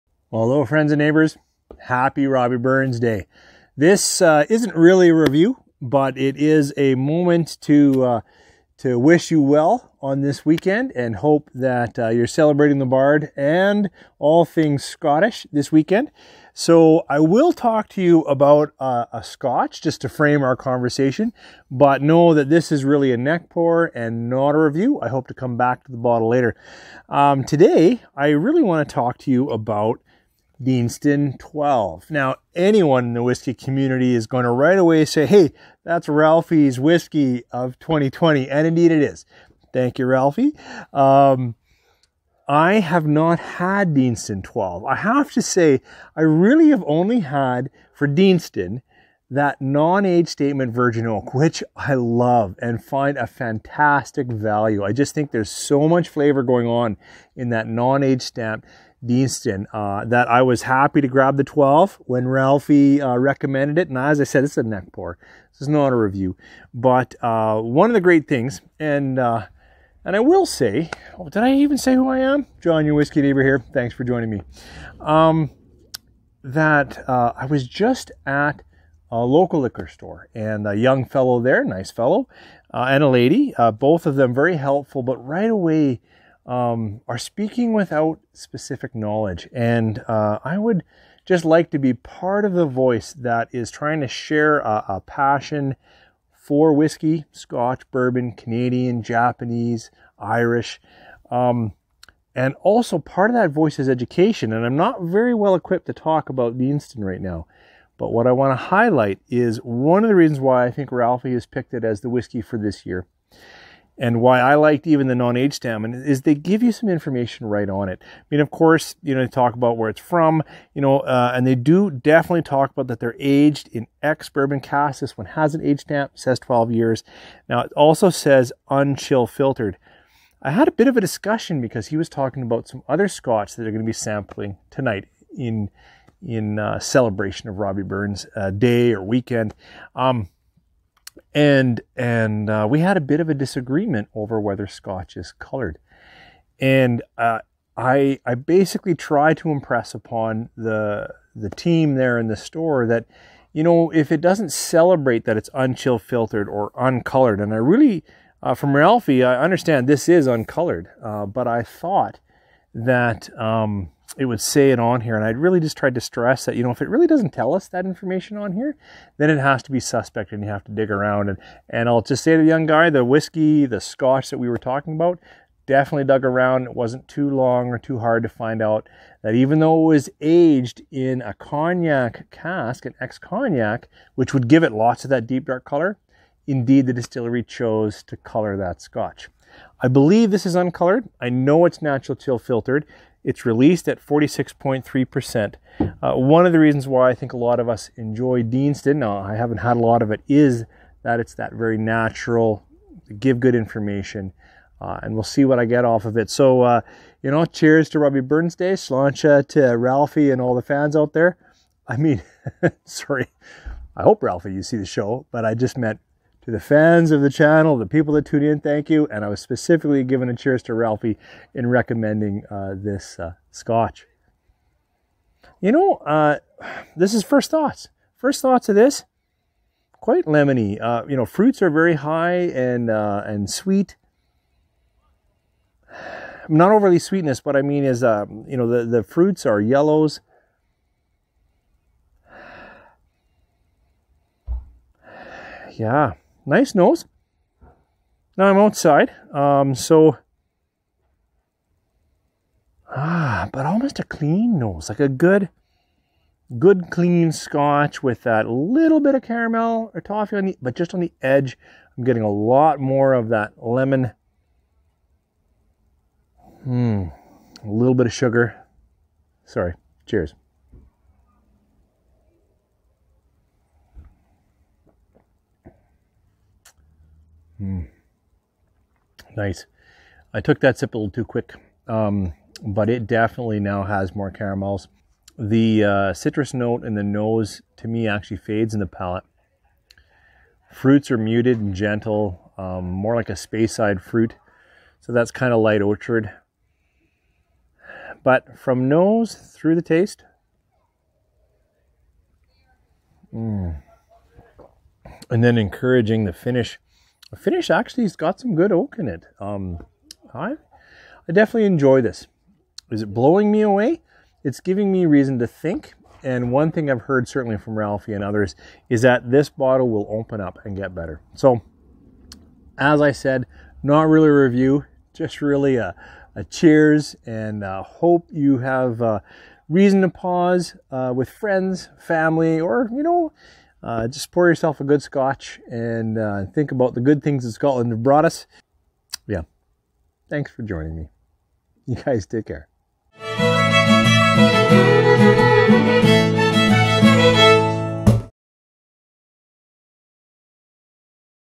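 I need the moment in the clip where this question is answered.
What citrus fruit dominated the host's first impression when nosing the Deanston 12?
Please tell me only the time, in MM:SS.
03:50.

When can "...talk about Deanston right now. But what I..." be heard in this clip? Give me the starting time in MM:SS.
01:45.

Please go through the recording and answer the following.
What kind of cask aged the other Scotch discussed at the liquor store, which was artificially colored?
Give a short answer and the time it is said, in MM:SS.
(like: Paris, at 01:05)
ex cognac, at 03:02.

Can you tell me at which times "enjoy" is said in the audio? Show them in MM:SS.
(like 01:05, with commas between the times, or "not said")
03:17, 05:11.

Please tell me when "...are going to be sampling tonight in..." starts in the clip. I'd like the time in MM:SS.
02:13.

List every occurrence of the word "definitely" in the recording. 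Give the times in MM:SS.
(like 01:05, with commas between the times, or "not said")
02:01, 02:55, 04:43, 05:11.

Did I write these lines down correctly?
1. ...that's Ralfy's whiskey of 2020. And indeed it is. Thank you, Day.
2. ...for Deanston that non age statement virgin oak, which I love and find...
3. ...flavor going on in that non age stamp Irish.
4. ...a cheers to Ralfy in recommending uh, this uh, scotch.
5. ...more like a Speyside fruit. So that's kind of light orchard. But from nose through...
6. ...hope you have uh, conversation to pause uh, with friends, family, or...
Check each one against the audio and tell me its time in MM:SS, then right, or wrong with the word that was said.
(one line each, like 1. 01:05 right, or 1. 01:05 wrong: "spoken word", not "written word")
1. 00:35 wrong: "Ralfy", not "Day"
2. 00:47 right
3. 00:56 wrong: "Deanston", not "Irish"
4. 03:40 right
5. 04:52 right
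6. 05:27 wrong: "reason", not "conversation".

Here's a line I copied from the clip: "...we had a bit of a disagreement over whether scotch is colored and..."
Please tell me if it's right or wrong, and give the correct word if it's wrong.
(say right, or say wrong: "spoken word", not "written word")
right.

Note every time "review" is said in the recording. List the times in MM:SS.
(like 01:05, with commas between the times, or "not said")
00:05, 00:24, 01:05, 05:24.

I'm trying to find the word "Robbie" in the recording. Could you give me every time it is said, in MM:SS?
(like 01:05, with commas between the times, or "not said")
00:02, 02:17, 03:27.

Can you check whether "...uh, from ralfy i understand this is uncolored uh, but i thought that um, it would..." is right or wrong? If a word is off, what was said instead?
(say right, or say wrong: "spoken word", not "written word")
right.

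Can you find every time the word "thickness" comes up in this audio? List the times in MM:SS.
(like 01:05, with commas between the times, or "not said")
not said.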